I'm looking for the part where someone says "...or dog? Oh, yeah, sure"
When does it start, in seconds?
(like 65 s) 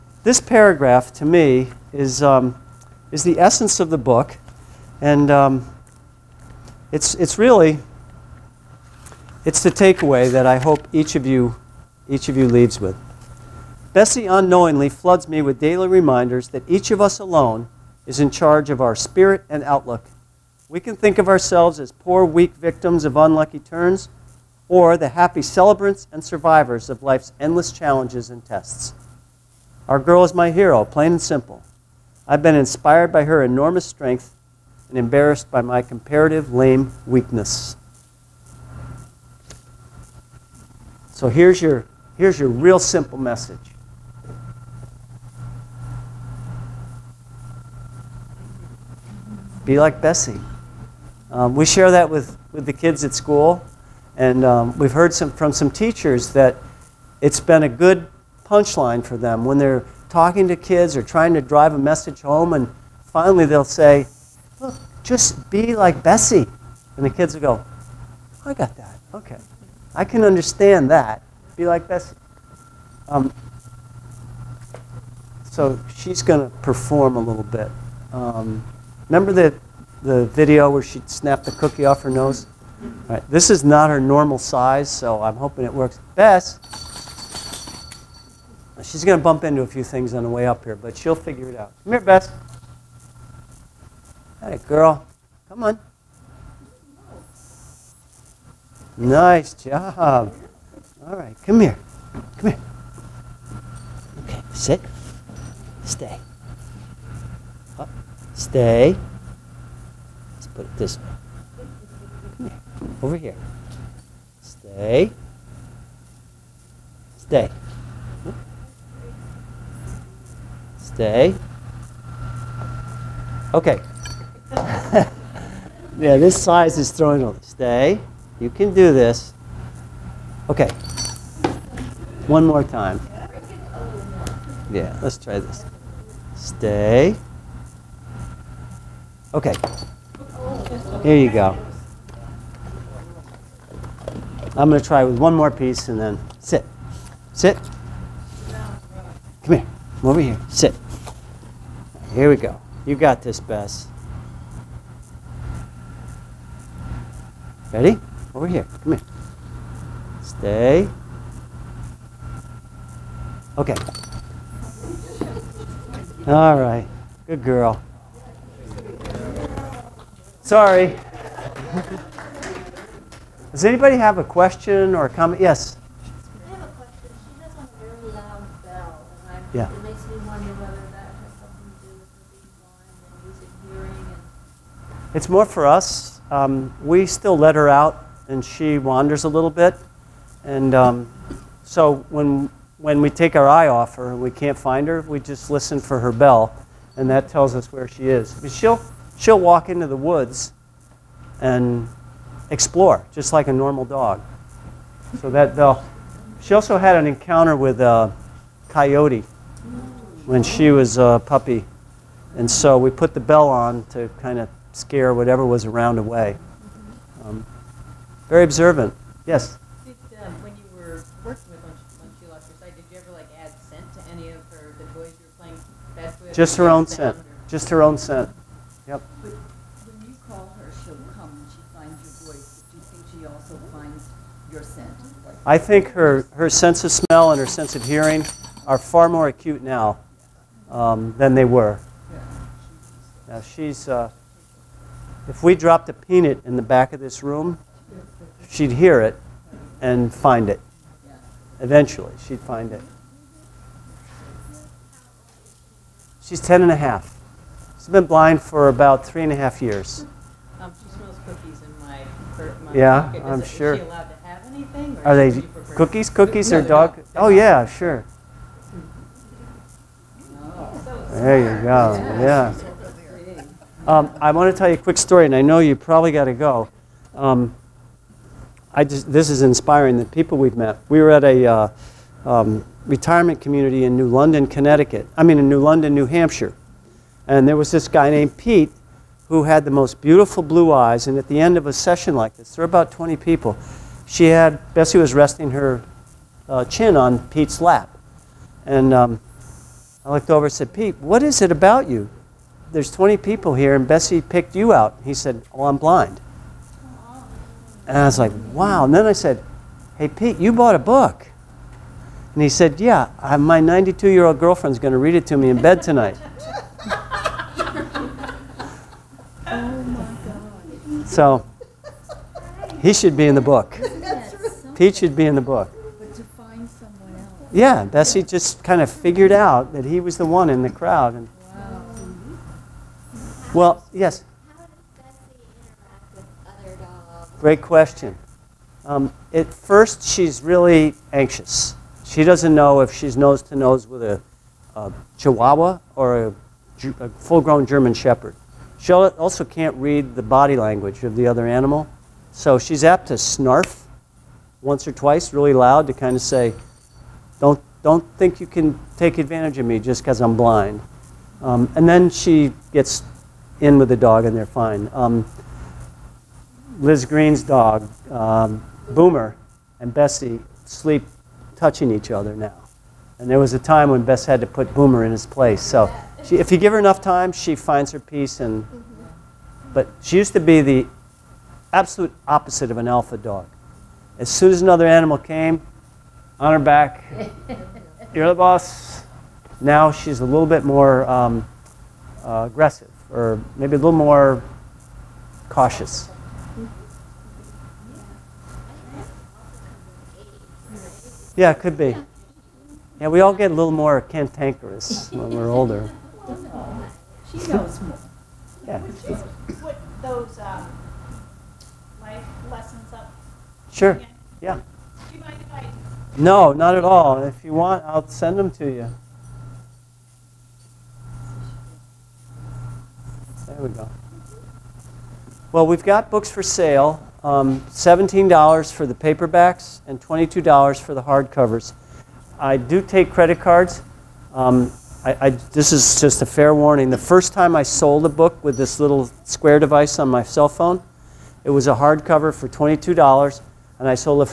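266 s.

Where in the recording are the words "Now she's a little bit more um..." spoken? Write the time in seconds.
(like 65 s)
389 s.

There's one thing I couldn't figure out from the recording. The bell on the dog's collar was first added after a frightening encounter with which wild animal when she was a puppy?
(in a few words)
Coyote.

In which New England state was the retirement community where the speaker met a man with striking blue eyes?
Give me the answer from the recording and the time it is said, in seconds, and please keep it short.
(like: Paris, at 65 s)
New Hampshire, at 285 s.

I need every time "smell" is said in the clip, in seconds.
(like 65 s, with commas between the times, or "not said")
236 s, 260 s.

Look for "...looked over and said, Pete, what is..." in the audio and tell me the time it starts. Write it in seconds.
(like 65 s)
300 s.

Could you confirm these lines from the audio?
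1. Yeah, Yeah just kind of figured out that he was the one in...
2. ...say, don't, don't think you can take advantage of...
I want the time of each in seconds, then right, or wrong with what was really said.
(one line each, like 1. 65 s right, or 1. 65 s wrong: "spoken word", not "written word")
1. 327 s wrong: "Bessie", not "Yeah"
2. 356 s right.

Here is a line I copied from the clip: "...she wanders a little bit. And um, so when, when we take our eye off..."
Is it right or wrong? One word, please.
right.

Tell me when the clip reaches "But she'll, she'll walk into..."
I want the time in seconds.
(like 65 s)
198 s.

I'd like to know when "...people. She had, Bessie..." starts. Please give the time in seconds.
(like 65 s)
293 s.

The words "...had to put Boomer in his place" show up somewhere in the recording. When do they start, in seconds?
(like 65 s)
374 s.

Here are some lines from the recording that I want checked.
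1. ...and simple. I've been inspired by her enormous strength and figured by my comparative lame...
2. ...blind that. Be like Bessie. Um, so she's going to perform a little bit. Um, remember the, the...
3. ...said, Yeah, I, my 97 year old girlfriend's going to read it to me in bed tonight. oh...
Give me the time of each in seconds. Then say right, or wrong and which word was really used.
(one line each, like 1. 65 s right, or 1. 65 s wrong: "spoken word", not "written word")
1. 31 s wrong: "embarrassed", not "figured"
2. 70 s wrong: "understand", not "blind"
3. 312 s wrong: "92", not "97".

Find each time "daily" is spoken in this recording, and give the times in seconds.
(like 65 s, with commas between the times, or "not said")
15 s.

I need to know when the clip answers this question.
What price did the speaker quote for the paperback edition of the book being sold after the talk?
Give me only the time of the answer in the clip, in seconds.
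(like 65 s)
427 s.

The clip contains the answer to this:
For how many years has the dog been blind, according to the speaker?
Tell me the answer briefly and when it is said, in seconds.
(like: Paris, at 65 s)
3 and a half, at 259 s.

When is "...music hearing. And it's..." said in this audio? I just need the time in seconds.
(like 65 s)
183 s.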